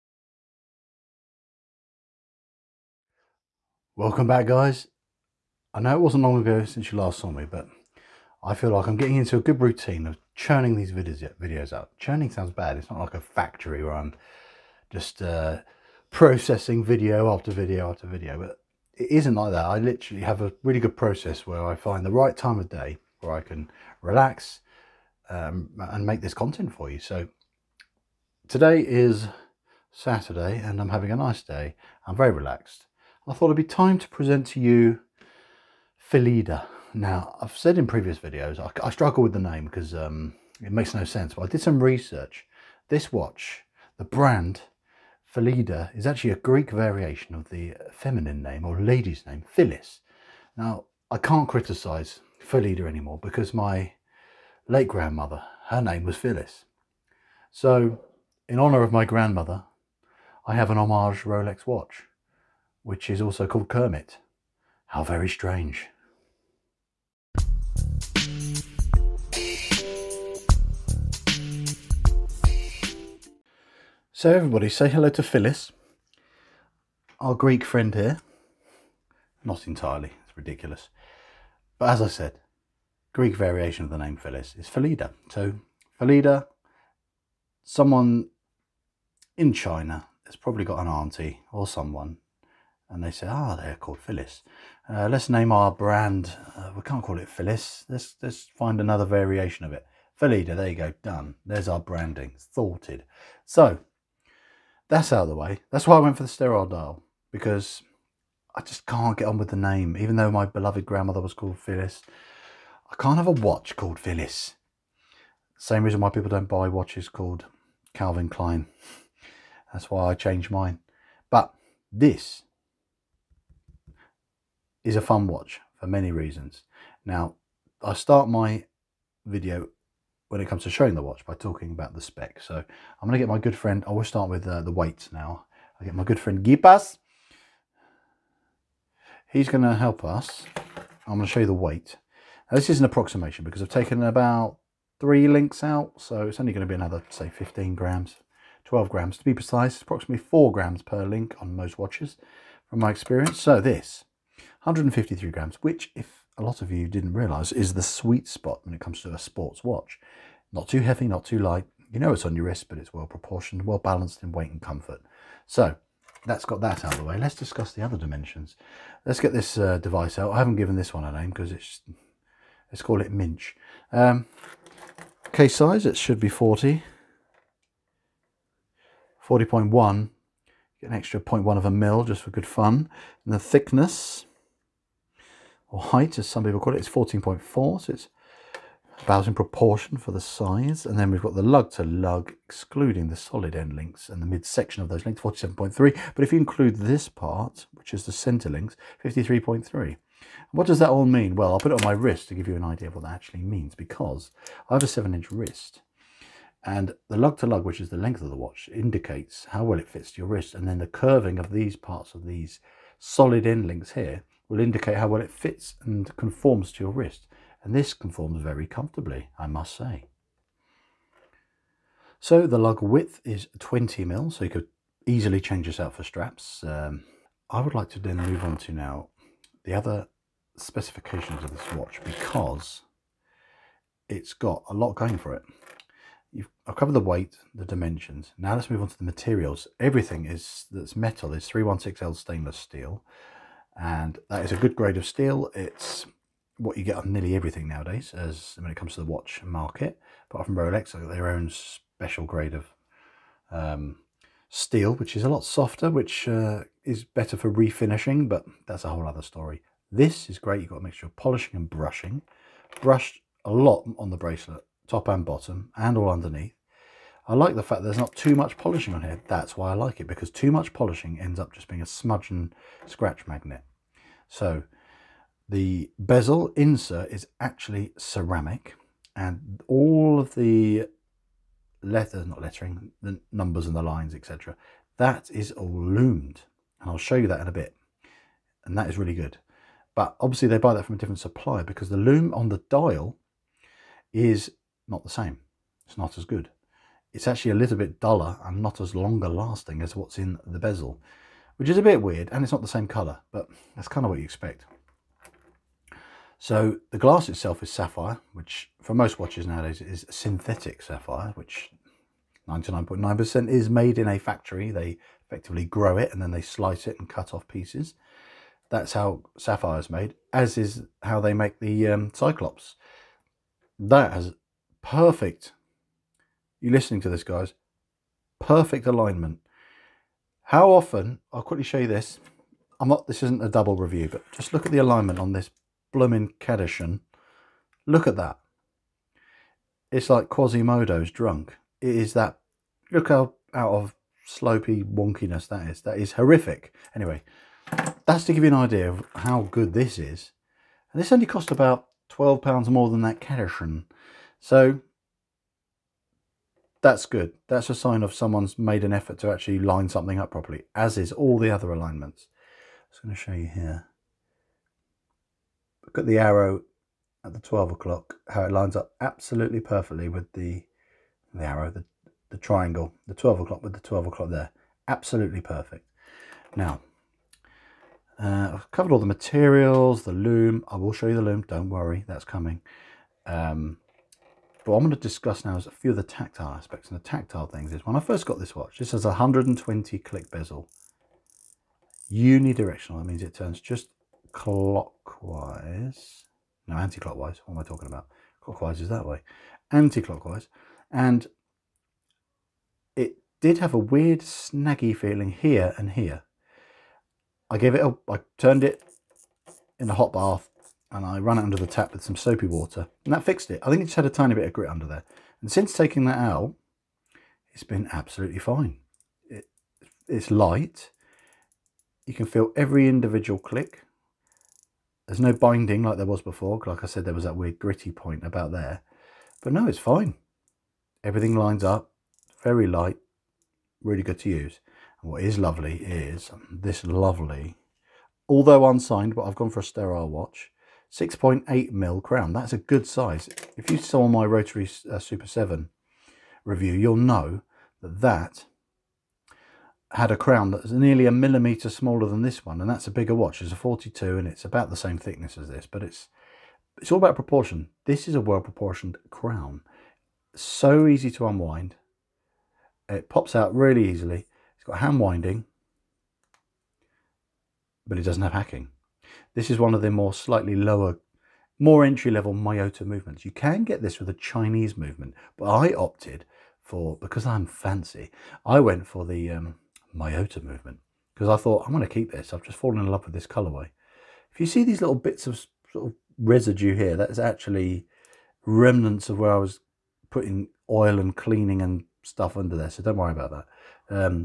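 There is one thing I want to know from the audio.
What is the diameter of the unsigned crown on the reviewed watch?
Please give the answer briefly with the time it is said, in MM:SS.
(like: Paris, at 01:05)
6.8 mm, at 07:20.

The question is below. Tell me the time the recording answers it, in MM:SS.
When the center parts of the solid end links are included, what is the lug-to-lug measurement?
03:19.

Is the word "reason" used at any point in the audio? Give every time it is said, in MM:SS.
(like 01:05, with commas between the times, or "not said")
01:55, 02:06.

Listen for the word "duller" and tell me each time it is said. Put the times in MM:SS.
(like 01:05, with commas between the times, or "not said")
04:57.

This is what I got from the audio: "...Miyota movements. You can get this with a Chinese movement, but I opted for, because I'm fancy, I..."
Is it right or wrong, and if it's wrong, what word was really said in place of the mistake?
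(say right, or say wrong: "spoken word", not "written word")
right.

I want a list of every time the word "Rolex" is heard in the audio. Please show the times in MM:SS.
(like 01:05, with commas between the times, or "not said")
01:01, 04:10.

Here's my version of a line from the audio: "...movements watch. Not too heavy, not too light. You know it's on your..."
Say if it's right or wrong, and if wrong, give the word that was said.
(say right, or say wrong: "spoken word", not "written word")
wrong: "sports", not "movements".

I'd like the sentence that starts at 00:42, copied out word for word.
This watch, the brand Phylida, is actually a Greek variation of the feminine name or lady's name, Phyllis.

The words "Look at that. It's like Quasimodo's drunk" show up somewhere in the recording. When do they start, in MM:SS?
05:37.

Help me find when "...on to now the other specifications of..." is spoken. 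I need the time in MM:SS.
03:48.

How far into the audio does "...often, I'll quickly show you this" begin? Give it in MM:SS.
05:30.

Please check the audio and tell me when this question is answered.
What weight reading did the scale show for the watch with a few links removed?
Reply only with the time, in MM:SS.
02:34.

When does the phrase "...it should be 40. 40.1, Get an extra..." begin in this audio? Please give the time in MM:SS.
02:55.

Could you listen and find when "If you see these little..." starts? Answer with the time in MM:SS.
08:04.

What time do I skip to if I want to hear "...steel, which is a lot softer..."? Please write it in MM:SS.
04:14.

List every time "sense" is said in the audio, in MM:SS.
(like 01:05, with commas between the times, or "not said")
00:41.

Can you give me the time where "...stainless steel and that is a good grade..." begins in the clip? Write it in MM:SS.
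04:02.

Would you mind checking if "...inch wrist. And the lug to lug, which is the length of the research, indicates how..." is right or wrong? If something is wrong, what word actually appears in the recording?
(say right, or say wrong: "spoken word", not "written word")
wrong: "watch", not "research".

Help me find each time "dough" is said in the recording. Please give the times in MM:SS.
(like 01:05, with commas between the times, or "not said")
not said.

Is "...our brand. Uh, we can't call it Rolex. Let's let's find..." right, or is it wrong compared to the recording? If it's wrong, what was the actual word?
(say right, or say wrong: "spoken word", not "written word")
wrong: "Phyllis", not "Rolex".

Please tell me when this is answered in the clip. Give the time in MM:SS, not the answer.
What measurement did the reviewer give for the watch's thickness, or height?
03:06.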